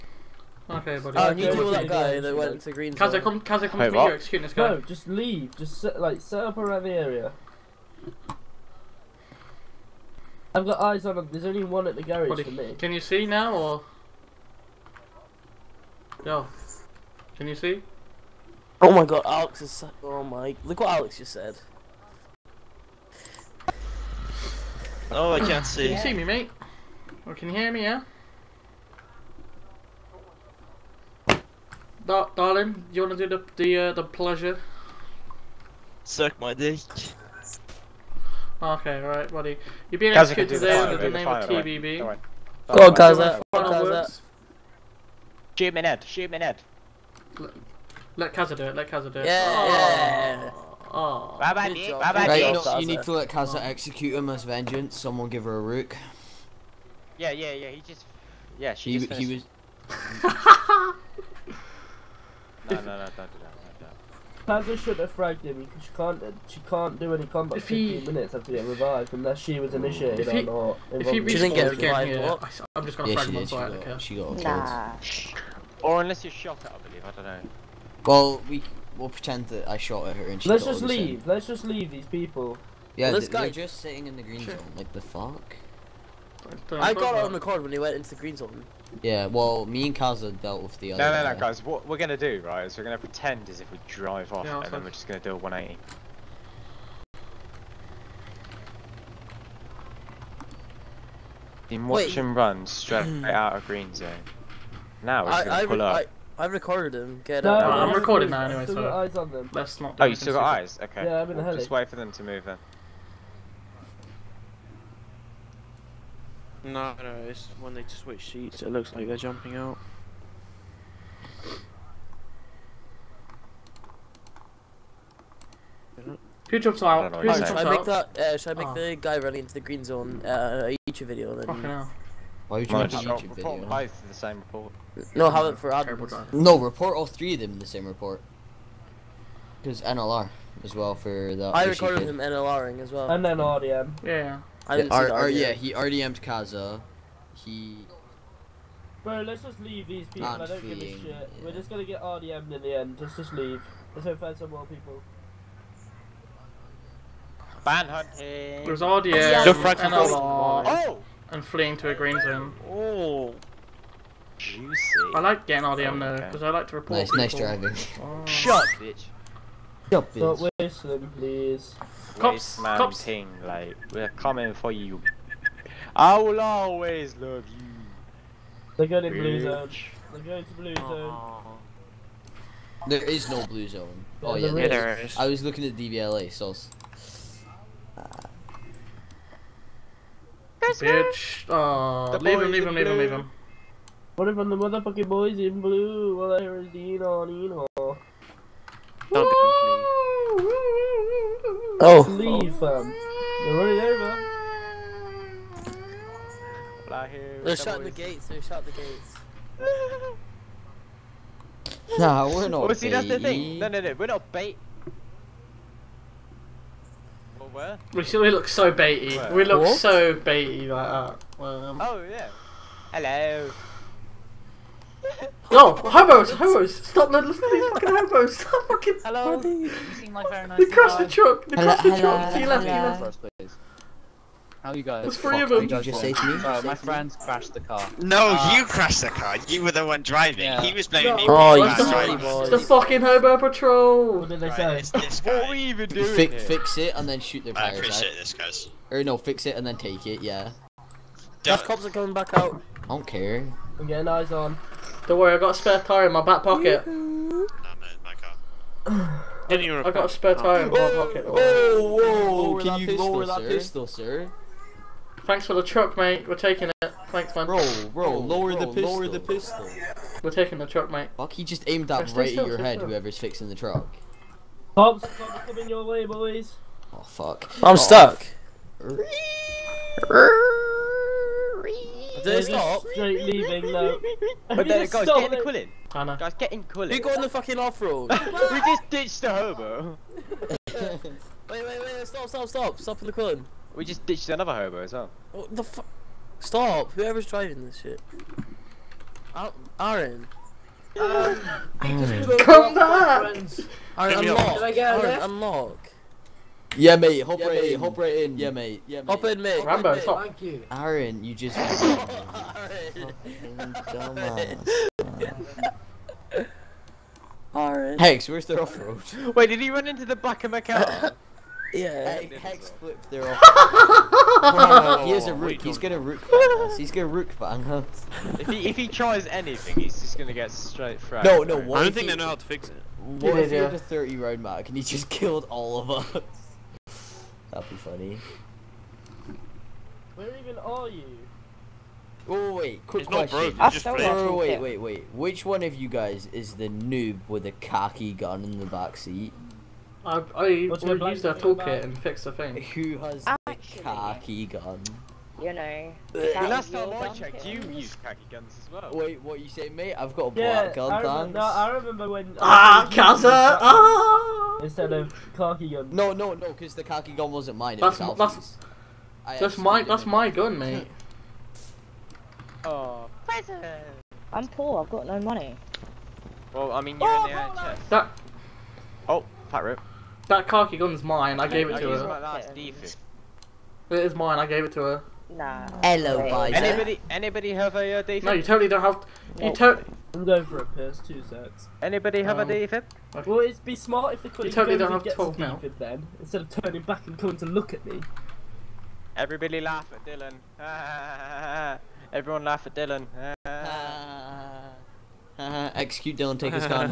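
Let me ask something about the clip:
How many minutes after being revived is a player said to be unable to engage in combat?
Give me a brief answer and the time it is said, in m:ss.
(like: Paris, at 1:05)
15, at 1:07.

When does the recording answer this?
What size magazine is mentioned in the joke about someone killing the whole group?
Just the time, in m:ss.
5:33.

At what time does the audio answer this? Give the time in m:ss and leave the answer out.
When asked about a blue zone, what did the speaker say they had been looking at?
3:05.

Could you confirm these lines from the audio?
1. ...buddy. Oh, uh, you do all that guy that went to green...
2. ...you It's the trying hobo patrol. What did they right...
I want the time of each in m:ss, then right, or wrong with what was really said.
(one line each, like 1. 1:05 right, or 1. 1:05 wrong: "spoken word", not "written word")
1. 0:00 right
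2. 4:01 wrong: "fucking", not "trying".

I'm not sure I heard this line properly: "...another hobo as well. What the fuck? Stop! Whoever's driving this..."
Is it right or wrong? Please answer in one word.
right.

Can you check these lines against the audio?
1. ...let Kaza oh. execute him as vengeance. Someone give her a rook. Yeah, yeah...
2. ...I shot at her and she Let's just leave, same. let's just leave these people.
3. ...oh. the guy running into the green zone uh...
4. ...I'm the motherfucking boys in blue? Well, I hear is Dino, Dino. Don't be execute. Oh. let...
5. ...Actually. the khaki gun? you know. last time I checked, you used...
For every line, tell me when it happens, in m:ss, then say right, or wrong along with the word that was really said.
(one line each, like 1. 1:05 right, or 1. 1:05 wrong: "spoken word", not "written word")
1. 0:53 right
2. 1:19 right
3. 2:08 right
4. 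3:14 wrong: "complete", not "execute"
5. 5:53 right.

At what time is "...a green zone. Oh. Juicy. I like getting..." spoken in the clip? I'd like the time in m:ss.
2:41.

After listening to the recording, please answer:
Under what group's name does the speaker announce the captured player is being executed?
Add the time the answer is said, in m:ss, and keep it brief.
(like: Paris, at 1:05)
TBB, at 0:41.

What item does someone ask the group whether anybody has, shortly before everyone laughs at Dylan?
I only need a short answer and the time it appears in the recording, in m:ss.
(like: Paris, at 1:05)
defib, at 6:32.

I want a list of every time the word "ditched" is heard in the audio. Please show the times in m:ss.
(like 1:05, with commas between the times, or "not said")
4:48, 4:54.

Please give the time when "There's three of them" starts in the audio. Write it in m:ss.
3:55.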